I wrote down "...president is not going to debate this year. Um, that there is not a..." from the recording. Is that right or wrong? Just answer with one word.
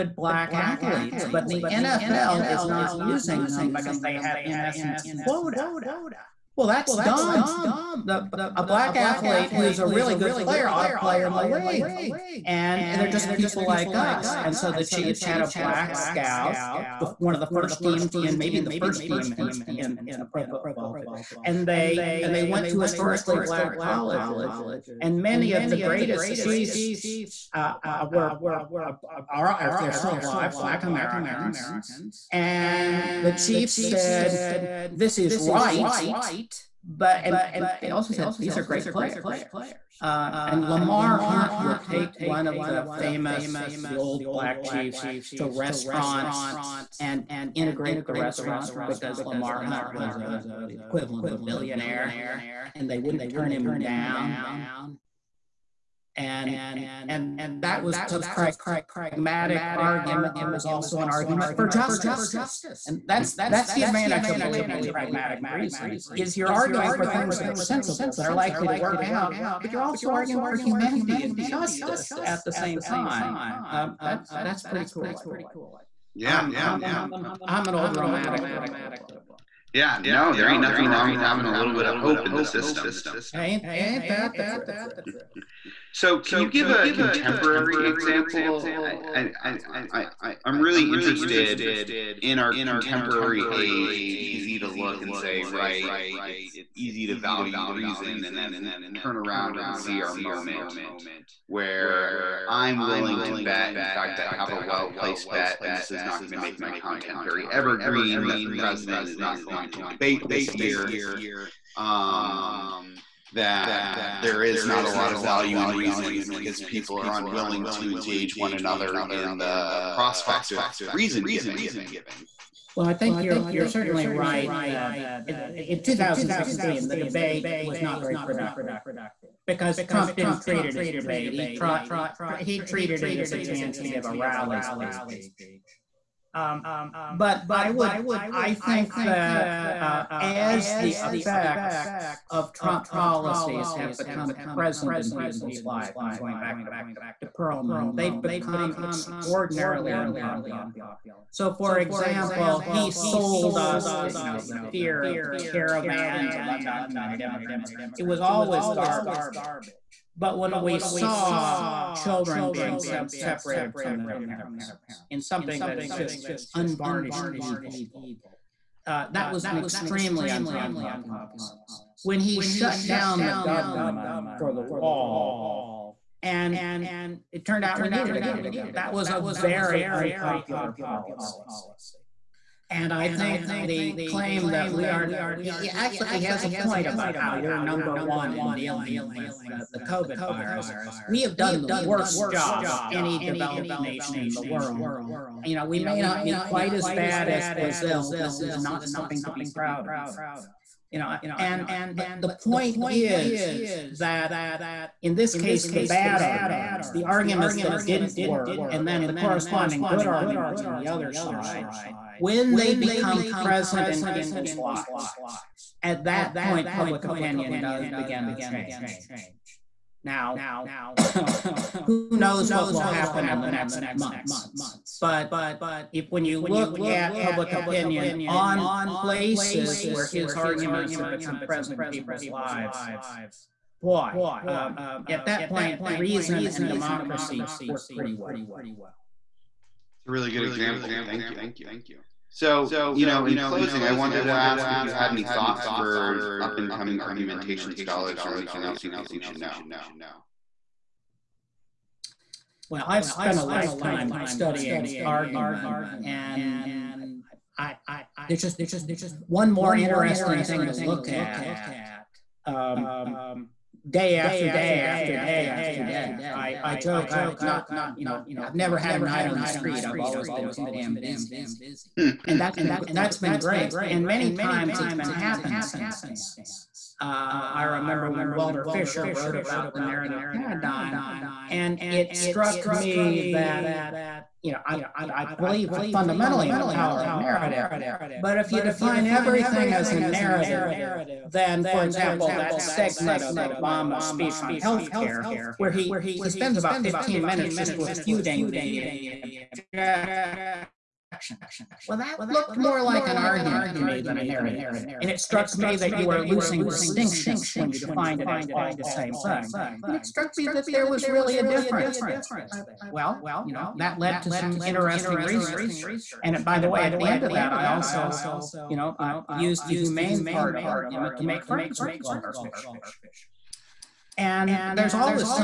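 right.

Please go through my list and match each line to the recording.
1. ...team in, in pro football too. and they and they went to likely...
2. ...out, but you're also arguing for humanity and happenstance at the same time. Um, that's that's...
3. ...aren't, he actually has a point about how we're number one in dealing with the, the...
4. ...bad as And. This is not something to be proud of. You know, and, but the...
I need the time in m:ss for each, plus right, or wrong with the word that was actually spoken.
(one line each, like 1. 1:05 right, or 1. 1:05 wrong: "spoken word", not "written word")
1. 0:19 wrong: "historically", not "likely"
2. 1:09 wrong: "justice", not "happenstance"
3. 3:04 right
4. 3:16 wrong: "Brazil", not "And".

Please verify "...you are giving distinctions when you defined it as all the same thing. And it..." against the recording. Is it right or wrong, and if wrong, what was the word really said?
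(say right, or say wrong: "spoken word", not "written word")
wrong: "losing", not "giving".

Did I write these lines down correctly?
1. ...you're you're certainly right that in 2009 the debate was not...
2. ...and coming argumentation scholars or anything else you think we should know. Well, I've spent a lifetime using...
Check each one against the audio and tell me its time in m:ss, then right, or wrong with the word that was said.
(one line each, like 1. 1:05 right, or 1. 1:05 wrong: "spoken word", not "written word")
1. 2:03 wrong: "2016", not "2009"
2. 4:06 wrong: "studying", not "using".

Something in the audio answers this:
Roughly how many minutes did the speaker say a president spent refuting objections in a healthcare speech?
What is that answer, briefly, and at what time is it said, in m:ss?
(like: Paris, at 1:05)
15, at 4:56.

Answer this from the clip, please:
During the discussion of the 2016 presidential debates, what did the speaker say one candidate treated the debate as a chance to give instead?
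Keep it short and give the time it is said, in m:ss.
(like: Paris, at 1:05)
A rally speech, at 2:14.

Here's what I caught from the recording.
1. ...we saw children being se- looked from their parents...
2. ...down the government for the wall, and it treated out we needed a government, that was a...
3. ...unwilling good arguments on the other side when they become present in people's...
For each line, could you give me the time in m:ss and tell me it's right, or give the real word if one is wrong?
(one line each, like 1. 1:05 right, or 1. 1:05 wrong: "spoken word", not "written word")
1. 2:40 wrong: "separated", not "looked"
2. 2:52 wrong: "turned", not "treated"
3. 3:29 wrong: "corresponding", not "unwilling".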